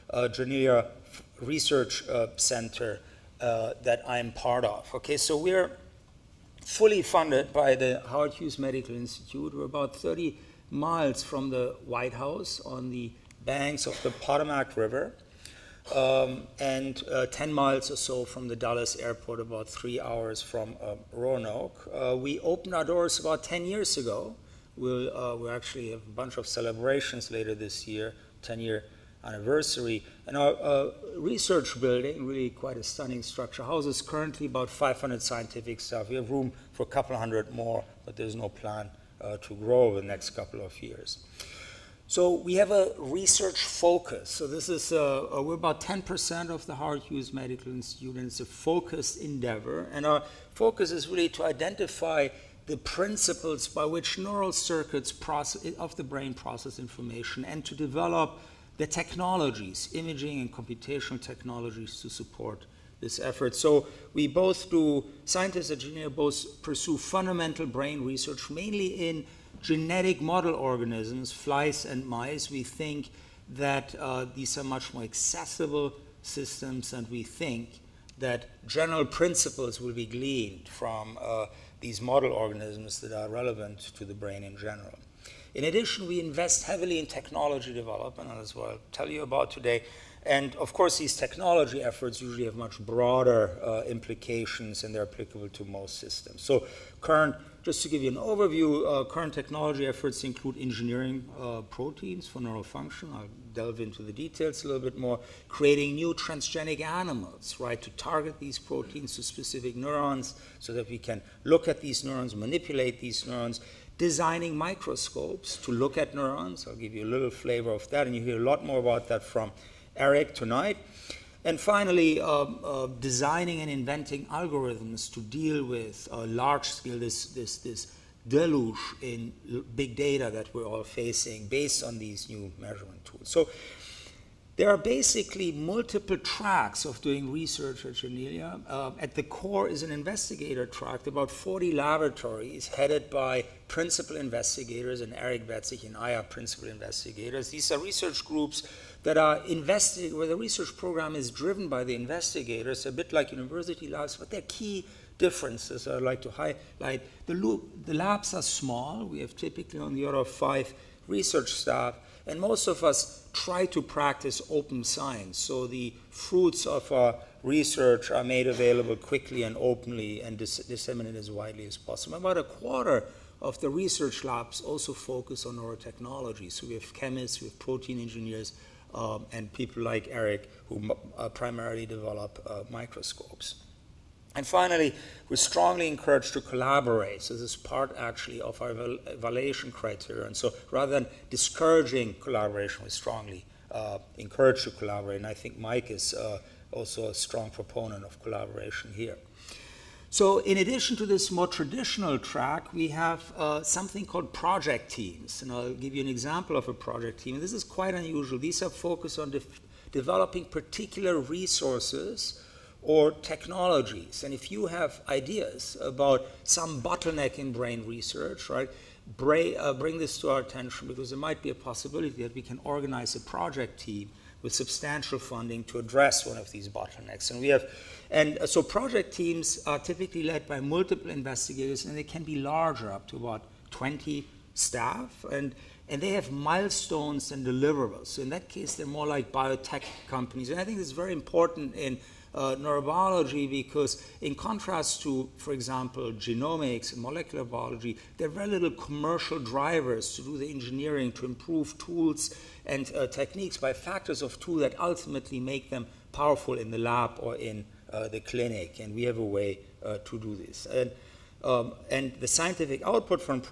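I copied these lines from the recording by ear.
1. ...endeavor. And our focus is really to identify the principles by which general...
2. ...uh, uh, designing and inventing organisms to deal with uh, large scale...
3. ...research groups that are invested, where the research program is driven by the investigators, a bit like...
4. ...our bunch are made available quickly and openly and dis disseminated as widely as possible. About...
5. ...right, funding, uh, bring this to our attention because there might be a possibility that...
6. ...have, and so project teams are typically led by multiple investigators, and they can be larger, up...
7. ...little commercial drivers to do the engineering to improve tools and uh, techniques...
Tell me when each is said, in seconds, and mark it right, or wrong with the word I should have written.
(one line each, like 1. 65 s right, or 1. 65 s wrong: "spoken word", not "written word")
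1. 49 s wrong: "neural", not "general"
2. 122 s wrong: "algorithms", not "organisms"
3. 147 s right
4. 166 s wrong: "research", not "bunch"
5. 218 s wrong: "bring", not "funding"
6. 227 s right
7. 248 s right.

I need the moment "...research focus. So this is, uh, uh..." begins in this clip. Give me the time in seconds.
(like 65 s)
42 s.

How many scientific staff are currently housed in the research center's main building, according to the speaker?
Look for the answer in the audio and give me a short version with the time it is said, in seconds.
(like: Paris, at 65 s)
500, at 34 s.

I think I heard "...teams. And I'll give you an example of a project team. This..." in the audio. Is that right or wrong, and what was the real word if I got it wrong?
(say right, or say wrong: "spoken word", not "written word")
right.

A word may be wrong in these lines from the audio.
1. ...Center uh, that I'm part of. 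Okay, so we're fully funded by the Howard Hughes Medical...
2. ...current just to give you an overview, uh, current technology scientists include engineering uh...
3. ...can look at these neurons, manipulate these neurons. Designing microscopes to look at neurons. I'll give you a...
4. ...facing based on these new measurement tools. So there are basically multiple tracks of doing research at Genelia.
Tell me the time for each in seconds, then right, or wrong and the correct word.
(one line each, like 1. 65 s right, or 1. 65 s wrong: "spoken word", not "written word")
1. 2 s right
2. 96 s wrong: "efforts", not "scientists"
3. 110 s right
4. 130 s right.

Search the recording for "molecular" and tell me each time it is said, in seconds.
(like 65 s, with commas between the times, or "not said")
247 s.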